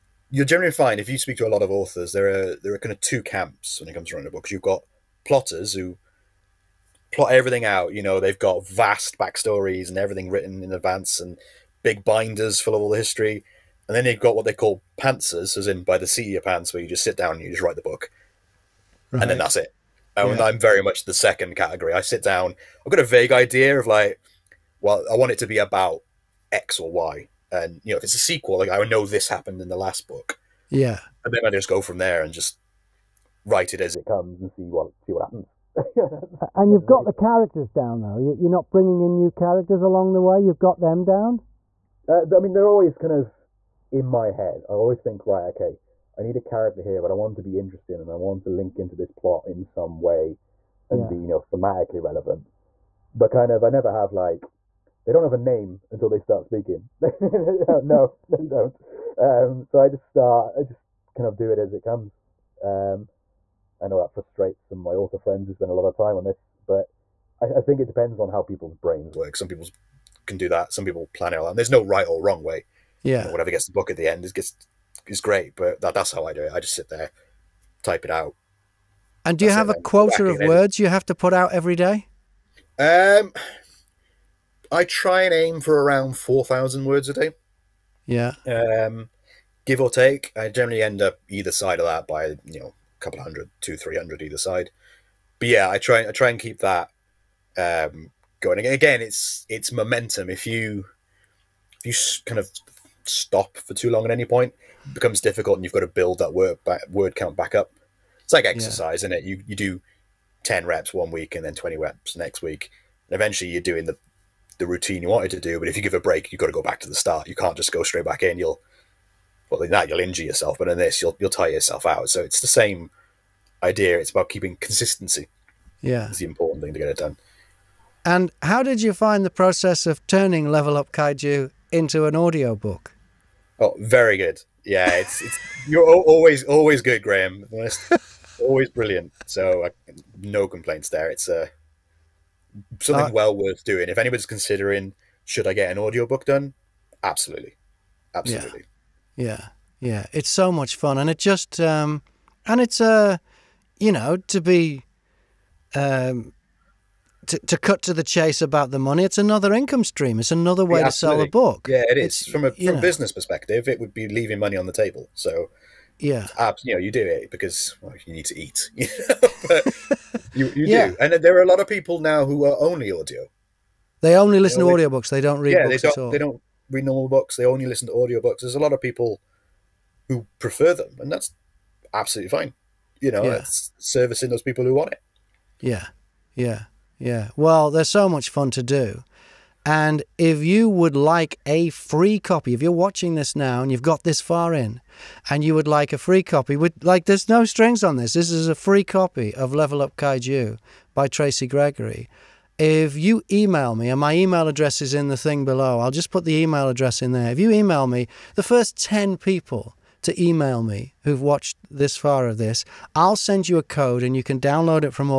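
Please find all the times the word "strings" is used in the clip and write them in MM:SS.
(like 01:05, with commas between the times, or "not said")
03:17.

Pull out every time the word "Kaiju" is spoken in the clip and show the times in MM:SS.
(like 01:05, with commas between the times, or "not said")
02:10, 03:19.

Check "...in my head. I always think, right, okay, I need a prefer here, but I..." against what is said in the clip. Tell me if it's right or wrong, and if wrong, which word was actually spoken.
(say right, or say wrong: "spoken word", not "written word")
wrong: "character", not "prefer".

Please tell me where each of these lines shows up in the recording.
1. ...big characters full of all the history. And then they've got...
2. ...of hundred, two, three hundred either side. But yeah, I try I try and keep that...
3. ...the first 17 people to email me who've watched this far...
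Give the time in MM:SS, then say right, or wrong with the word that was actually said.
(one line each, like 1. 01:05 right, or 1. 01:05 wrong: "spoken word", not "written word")
1. 00:11 wrong: "binders", not "characters"
2. 01:33 right
3. 03:28 wrong: "10", not "17".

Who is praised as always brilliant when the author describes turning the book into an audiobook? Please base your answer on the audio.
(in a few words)
Graham.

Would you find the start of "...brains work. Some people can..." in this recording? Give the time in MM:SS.
01:08.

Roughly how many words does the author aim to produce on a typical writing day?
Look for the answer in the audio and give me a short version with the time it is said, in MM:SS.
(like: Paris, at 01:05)
4000, at 01:26.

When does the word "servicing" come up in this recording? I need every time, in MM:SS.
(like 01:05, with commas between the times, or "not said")
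03:03.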